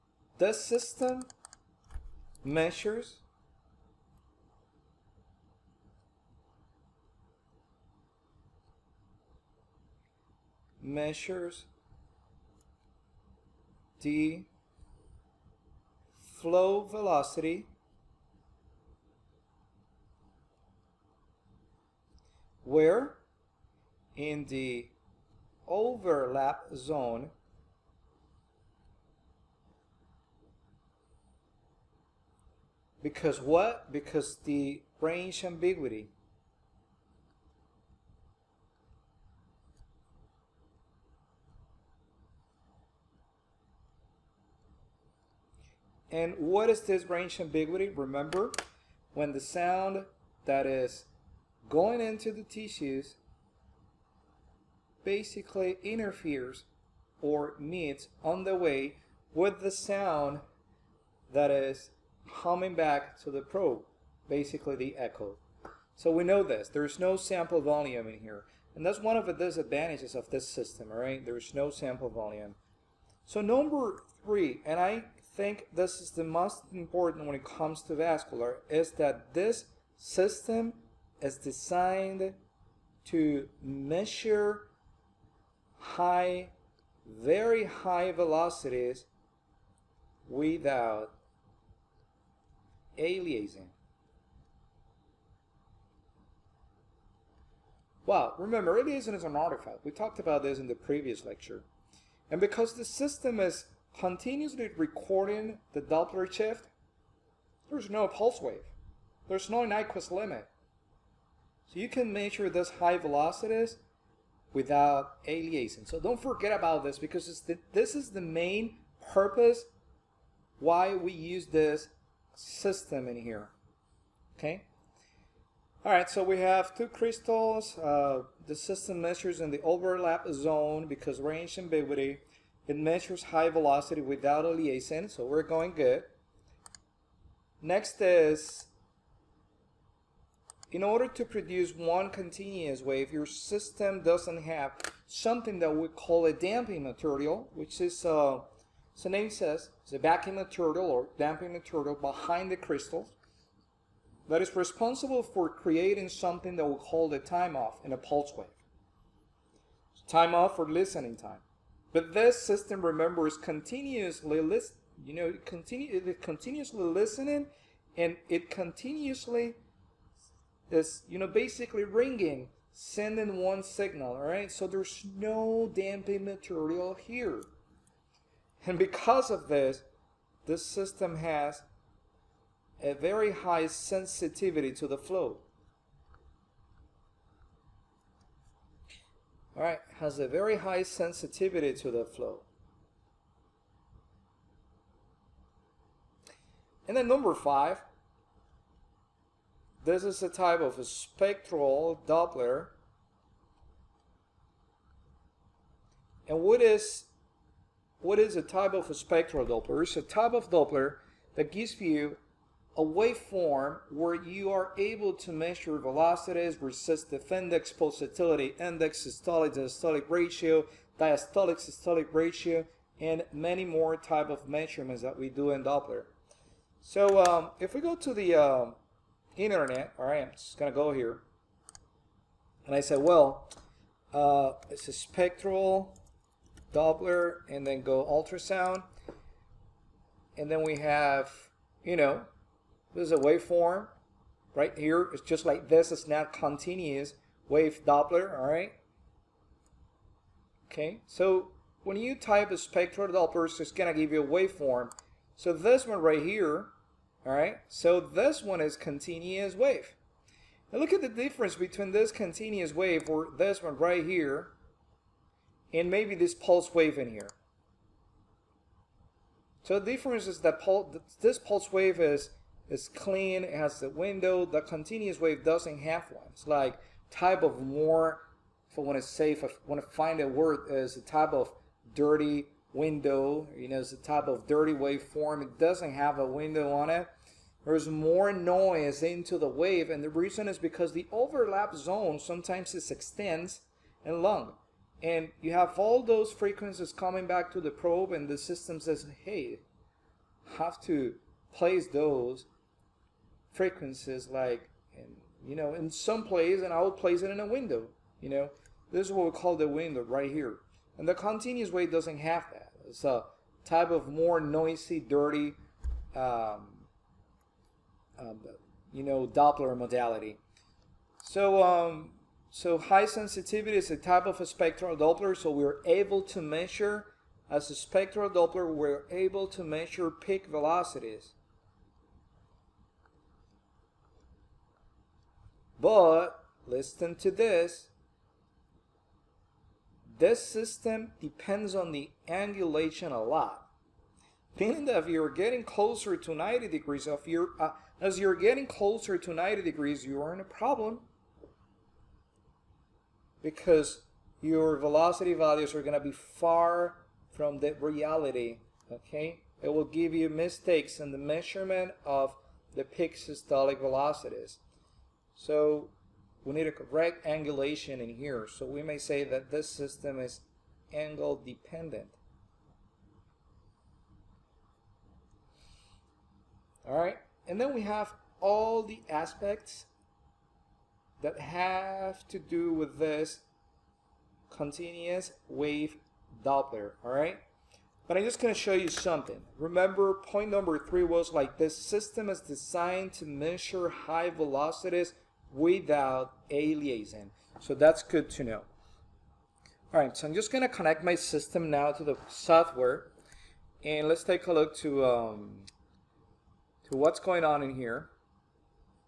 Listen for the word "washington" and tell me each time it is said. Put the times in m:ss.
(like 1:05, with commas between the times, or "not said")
not said.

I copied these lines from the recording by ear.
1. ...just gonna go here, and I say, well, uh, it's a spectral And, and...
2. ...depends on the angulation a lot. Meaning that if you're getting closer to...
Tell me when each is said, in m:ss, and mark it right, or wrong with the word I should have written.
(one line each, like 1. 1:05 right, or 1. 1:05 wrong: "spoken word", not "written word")
1. 3:50 wrong: "Doppler", not "And"
2. 5:41 right.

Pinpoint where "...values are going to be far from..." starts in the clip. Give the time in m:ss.
5:55.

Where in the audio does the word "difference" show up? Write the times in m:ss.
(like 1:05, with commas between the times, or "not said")
4:21, 4:29.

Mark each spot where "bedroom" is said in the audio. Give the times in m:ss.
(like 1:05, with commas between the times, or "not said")
not said.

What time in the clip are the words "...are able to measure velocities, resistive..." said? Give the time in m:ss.
3:34.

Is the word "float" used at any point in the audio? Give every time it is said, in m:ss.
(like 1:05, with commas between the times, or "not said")
not said.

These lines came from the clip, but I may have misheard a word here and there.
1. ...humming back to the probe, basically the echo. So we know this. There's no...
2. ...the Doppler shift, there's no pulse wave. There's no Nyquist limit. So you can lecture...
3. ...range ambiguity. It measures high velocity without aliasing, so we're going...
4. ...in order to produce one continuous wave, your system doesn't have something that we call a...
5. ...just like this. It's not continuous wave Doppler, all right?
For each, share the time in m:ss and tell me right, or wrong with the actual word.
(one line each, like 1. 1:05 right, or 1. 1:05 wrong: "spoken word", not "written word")
1. 1:02 right
2. 1:45 wrong: "measure", not "lecture"
3. 2:11 right
4. 2:20 right
5. 4:05 right.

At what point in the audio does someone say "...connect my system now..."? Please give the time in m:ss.
6:40.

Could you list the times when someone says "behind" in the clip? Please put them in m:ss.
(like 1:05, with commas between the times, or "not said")
2:31.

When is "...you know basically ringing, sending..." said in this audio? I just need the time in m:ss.
2:51.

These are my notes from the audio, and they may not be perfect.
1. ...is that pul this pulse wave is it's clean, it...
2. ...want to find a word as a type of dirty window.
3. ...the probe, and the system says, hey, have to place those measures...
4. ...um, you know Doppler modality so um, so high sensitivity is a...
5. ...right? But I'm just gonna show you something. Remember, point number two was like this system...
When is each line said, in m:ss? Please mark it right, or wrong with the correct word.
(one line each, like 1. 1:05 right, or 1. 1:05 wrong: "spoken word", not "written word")
1. 4:30 right
2. 4:39 right
3. 4:57 wrong: "frequencies", not "measures"
4. 5:18 right
5. 6:27 wrong: "three", not "two".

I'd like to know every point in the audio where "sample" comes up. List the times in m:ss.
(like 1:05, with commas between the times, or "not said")
1:07, 1:11.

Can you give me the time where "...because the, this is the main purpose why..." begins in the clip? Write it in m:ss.
1:56.